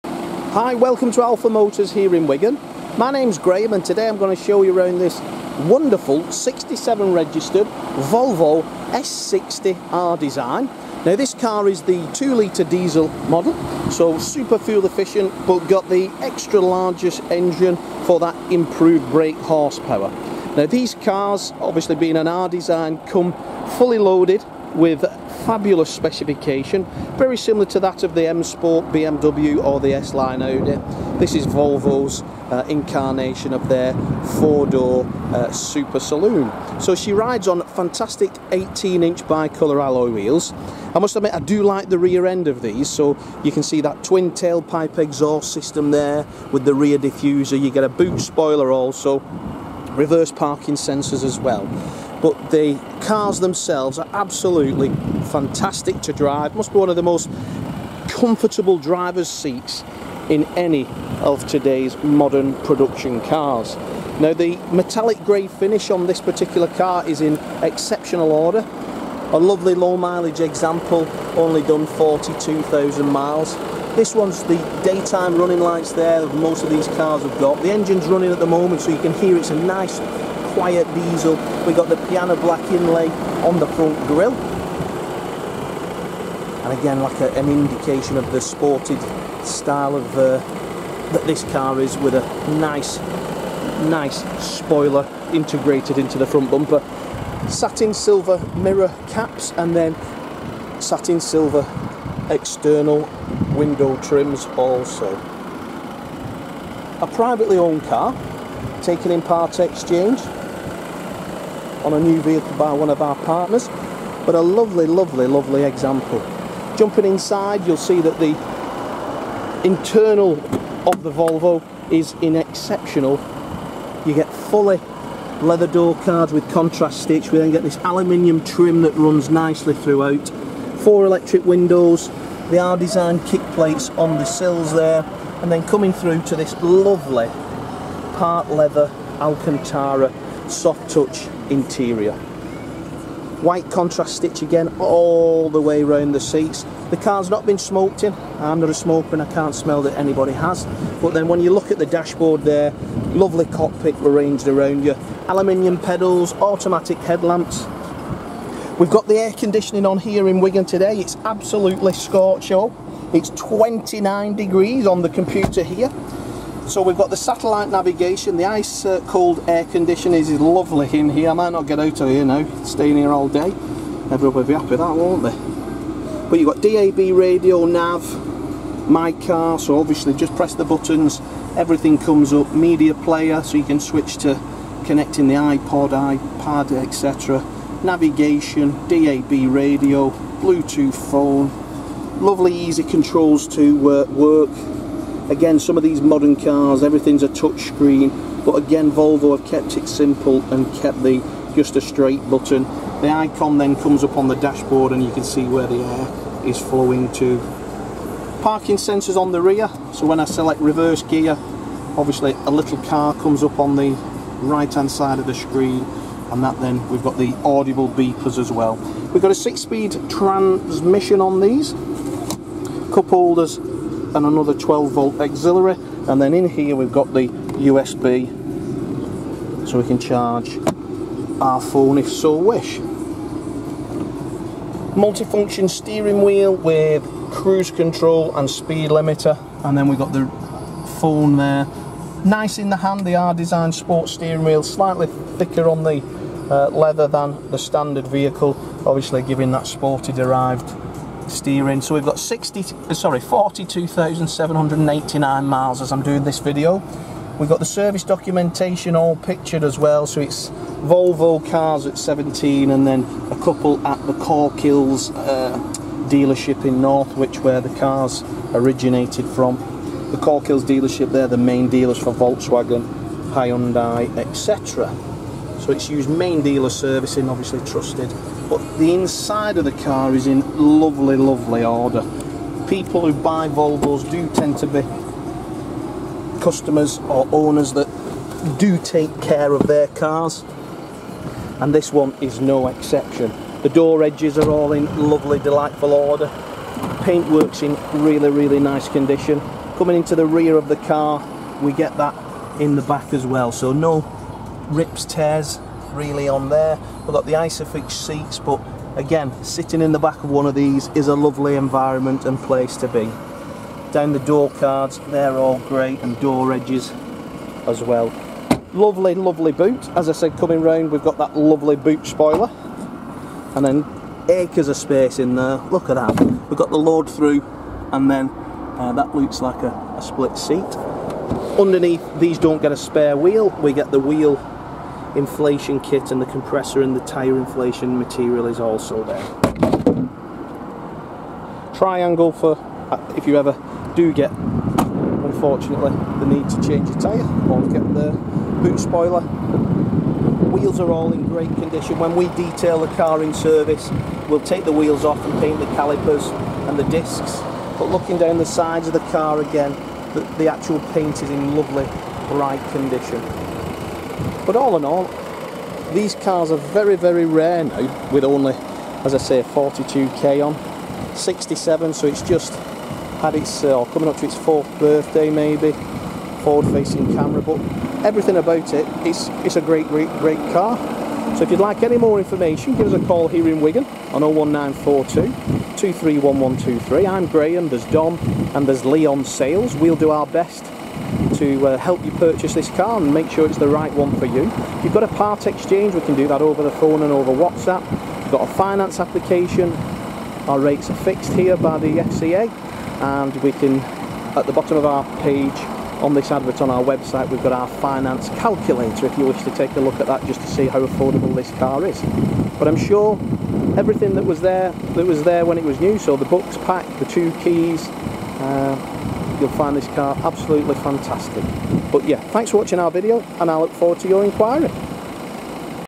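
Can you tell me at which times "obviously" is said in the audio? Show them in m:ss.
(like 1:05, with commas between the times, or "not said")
0:21, 2:59, 3:31, 4:08, 4:37.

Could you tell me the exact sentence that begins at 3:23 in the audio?
The icon then comes up on the dashboard and you can see where the air is flowing to.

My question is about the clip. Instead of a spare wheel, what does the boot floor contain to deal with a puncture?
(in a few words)
wheel inflation kit.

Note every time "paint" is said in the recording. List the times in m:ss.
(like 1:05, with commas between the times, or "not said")
4:57, 5:55, 6:00.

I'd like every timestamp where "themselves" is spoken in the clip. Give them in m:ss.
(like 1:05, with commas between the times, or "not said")
0:53.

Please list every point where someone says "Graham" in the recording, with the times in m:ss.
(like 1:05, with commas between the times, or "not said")
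0:03, 6:27.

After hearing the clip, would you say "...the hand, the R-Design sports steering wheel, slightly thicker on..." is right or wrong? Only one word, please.
right.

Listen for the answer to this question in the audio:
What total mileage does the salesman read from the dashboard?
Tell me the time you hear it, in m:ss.
4:13.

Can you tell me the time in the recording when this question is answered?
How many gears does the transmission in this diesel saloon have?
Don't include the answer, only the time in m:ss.
3:39.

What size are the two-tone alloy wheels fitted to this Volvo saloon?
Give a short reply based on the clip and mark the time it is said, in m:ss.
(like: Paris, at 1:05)
18-inch, at 0:38.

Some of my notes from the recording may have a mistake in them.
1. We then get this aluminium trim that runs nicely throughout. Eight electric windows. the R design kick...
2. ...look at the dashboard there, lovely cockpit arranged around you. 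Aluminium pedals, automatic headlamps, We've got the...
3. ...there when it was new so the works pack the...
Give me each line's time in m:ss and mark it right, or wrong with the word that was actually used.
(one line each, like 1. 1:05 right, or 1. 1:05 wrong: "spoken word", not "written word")
1. 2:07 wrong: "Four", not "Eight"
2. 2:31 right
3. 6:55 wrong: "books", not "works".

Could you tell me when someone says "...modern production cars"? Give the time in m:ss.
1:02.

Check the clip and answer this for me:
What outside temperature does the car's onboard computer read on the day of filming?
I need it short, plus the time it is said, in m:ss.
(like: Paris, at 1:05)
29 degrees, at 2:43.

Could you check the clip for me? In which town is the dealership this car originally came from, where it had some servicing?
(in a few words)
Northwich.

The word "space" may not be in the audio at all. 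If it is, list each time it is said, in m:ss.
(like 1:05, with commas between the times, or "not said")
5:24.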